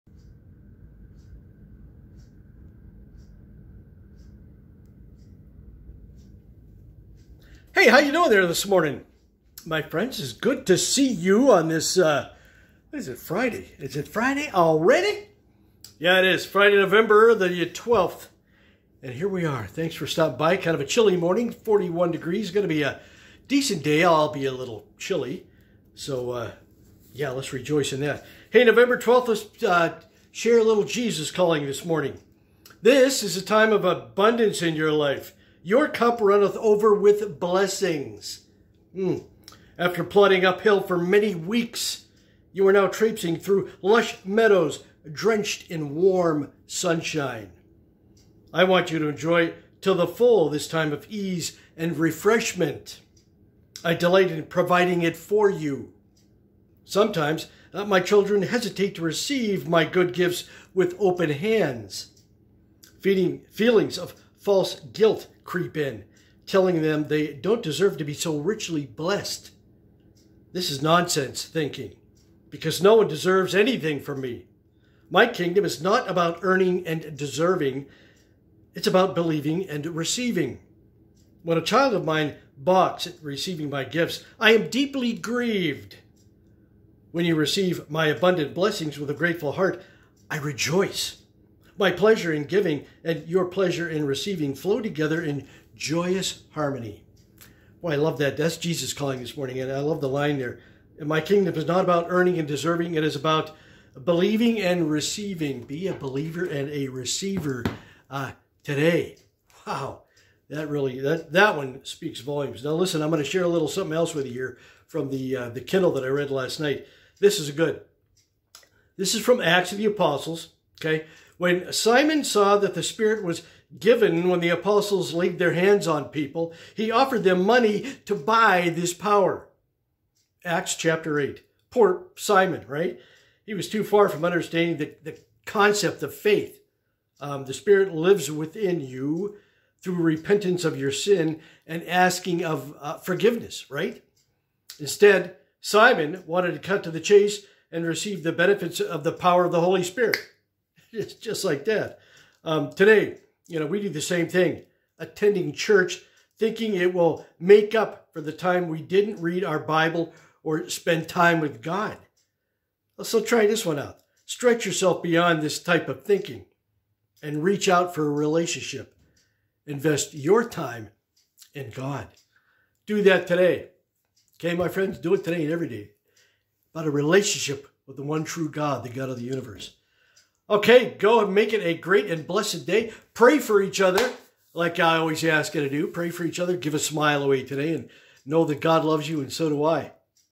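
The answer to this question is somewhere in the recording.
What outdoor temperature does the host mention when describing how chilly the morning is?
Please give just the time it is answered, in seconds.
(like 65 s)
21 s.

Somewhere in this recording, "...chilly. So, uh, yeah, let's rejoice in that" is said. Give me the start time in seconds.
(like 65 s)
24 s.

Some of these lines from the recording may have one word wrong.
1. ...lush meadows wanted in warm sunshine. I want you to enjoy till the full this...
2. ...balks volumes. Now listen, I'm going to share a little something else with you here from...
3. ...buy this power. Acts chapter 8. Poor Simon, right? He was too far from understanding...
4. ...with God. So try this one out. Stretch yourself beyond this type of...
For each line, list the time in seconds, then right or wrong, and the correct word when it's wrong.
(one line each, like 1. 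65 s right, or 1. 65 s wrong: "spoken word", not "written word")
1. 43 s wrong: "drenched", not "wanted"
2. 111 s wrong: "speaks", not "balks"
3. 128 s right
4. 161 s right.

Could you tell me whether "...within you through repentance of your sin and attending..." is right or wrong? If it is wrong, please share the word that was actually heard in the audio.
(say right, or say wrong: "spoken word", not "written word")
wrong: "asking", not "attending".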